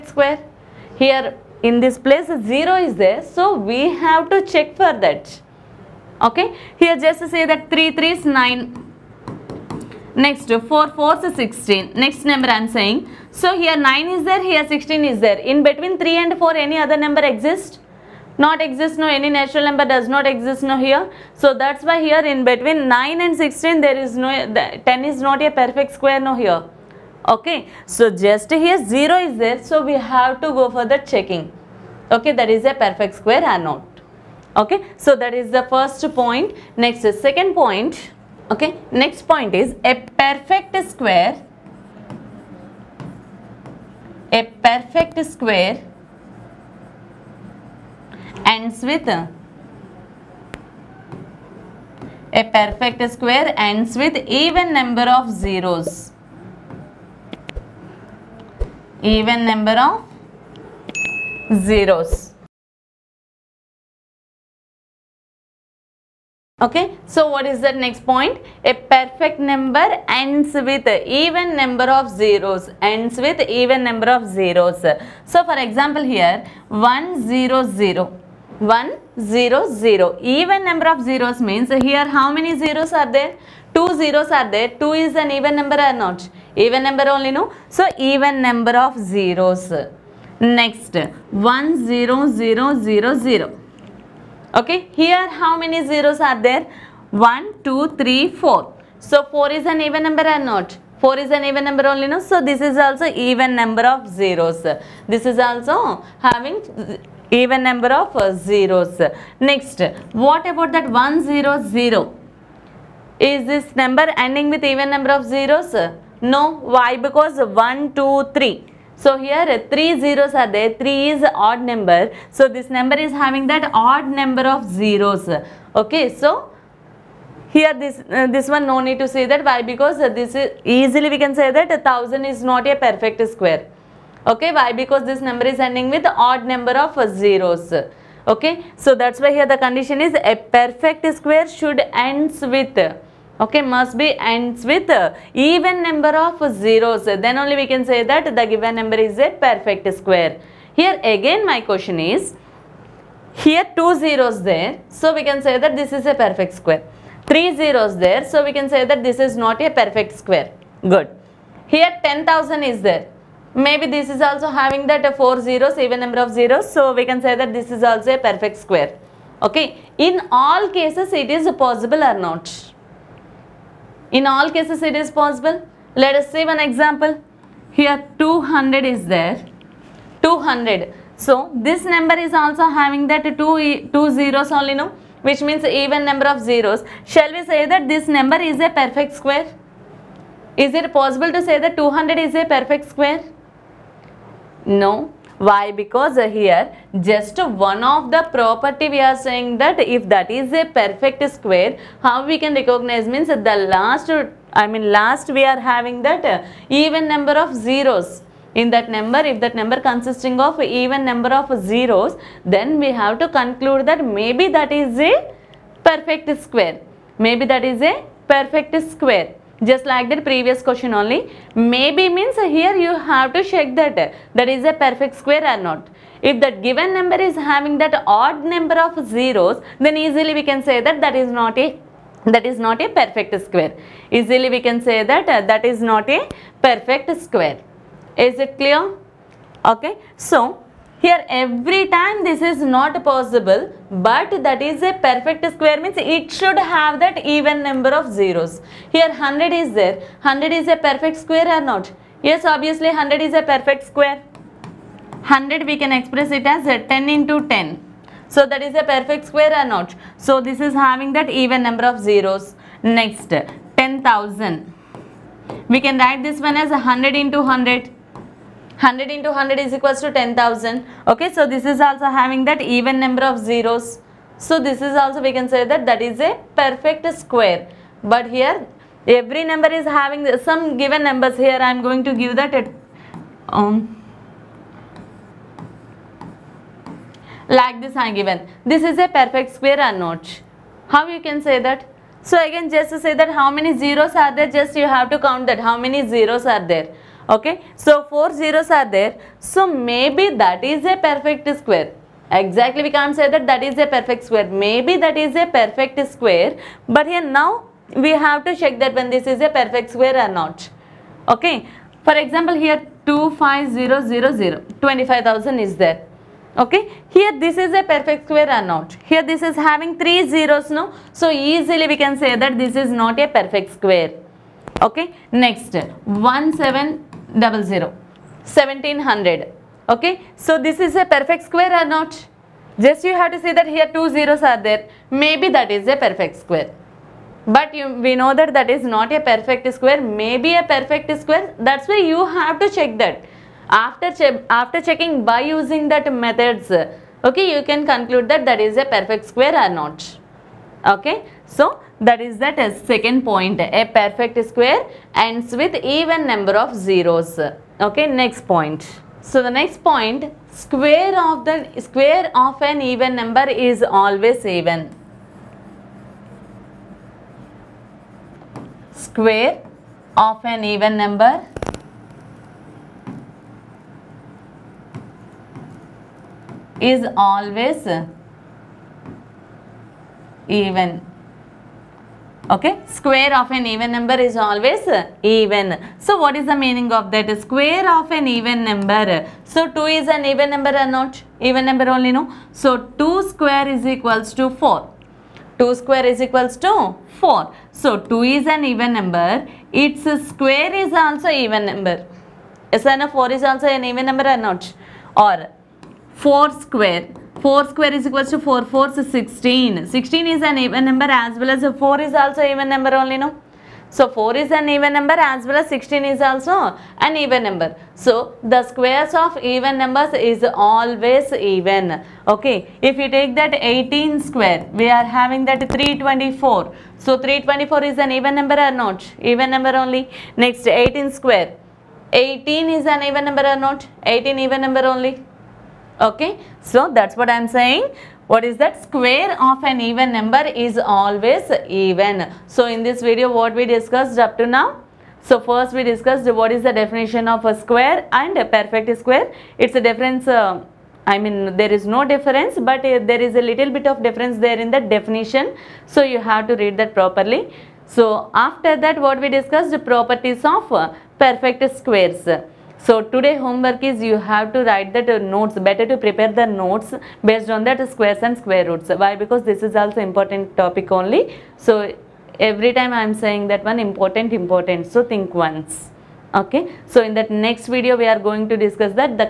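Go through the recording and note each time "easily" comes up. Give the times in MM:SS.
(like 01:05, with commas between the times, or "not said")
02:10, 03:49, 03:54, 05:21.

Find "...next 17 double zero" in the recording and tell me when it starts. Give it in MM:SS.
05:25.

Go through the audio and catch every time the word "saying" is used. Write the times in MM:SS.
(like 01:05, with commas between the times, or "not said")
00:12, 03:19, 07:17, 07:53.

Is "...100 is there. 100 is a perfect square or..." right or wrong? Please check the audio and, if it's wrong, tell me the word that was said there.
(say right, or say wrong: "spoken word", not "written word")
right.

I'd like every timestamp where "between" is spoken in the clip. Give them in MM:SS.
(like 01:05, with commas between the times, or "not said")
00:15, 00:22.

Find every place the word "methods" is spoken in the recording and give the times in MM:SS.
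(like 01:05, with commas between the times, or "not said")
05:46.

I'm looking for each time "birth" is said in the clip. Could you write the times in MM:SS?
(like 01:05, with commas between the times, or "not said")
not said.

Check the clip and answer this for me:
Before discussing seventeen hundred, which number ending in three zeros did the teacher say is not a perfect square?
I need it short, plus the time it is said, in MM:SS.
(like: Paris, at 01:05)
25000, at 05:13.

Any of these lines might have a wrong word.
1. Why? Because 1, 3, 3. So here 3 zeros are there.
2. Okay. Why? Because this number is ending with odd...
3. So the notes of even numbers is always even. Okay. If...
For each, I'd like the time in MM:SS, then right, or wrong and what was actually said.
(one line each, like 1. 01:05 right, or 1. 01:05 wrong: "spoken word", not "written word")
1. 01:56 wrong: "2", not "3"
2. 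02:14 right
3. 06:57 wrong: "squares", not "notes".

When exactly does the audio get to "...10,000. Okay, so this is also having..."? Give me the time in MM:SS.
04:30.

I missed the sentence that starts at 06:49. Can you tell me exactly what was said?
16 is an even number as well as 4 is also even number only, no?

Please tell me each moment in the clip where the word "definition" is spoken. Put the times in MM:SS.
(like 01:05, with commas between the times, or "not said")
07:26, 07:34.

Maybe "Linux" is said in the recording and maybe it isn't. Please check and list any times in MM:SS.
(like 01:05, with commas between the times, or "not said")
not said.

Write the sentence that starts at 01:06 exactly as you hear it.
Okay, so what is the next point?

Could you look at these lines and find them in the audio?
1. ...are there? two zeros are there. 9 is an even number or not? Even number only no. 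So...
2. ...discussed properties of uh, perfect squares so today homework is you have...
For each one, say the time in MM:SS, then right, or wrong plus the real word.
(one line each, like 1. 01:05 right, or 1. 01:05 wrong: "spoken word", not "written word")
1. 01:22 wrong: "2", not "9"
2. 07:39 right.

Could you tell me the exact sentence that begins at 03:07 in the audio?
Shall we say that this number is a perfect square?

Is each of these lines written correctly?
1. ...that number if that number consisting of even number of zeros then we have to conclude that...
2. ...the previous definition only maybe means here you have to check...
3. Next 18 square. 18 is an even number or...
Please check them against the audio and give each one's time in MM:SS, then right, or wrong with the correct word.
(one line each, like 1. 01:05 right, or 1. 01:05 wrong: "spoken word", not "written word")
1. 03:28 right
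2. 03:40 wrong: "question", not "definition"
3. 07:10 right.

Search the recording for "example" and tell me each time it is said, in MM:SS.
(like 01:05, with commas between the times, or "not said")
01:15, 02:56, 05:12.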